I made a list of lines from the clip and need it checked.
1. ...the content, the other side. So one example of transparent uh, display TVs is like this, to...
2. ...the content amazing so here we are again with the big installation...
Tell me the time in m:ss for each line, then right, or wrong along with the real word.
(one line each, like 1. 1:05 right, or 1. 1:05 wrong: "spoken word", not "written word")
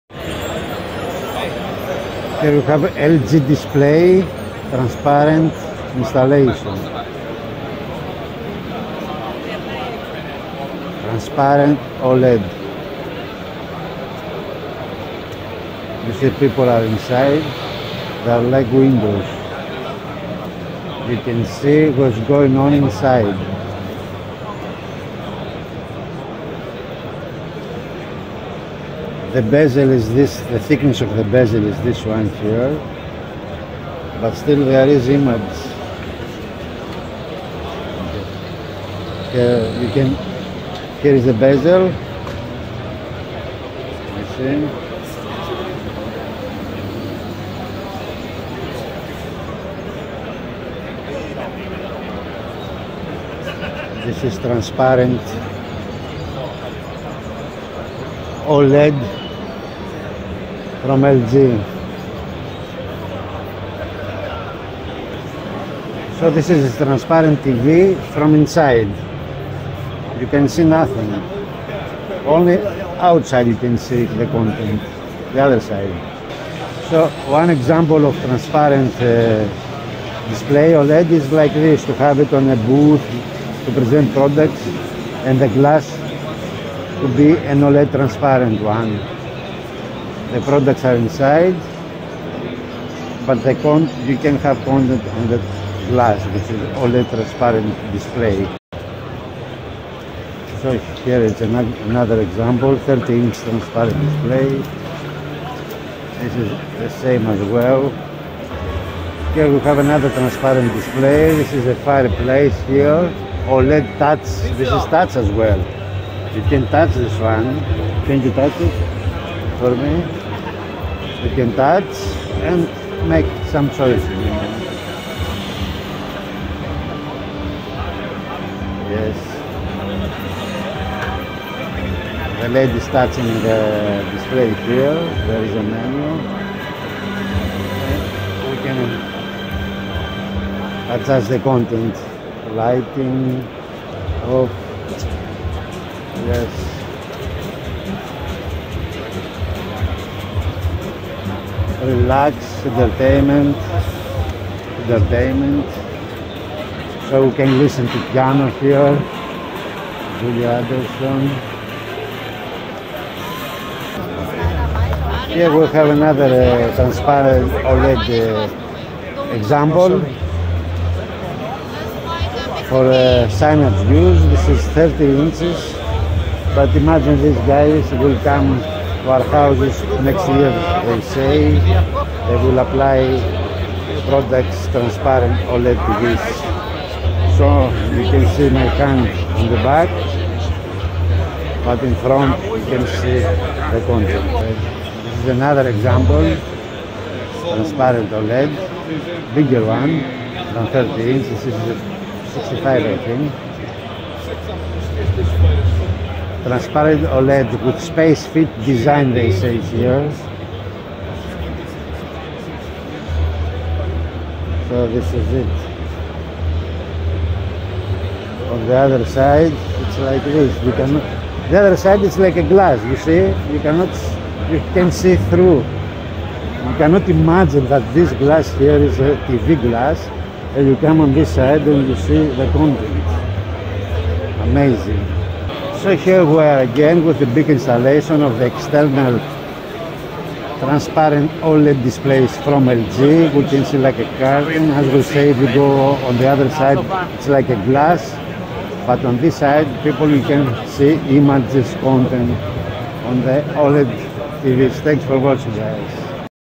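1. 1:14 wrong: "OLED", not "TVs"
2. 3:52 right.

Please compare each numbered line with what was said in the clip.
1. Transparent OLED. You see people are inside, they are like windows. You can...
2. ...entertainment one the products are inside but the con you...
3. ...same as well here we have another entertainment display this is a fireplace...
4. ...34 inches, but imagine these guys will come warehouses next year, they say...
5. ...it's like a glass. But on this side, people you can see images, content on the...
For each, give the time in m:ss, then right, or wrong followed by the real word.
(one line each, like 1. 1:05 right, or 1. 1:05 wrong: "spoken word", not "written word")
1. 0:11 right
2. 1:27 wrong: "transparent", not "entertainment"
3. 1:47 wrong: "transparent", not "entertainment"
4. 2:54 wrong: "30", not "34"
5. 4:07 right.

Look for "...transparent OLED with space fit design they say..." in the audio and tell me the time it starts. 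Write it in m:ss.
3:26.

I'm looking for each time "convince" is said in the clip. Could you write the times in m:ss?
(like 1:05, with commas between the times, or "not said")
not said.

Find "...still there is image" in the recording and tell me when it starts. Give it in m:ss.
0:34.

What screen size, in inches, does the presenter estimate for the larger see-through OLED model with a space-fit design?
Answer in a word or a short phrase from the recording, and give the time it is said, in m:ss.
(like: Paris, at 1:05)
65, at 3:22.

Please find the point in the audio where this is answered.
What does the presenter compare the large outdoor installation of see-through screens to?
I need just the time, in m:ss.
4:03.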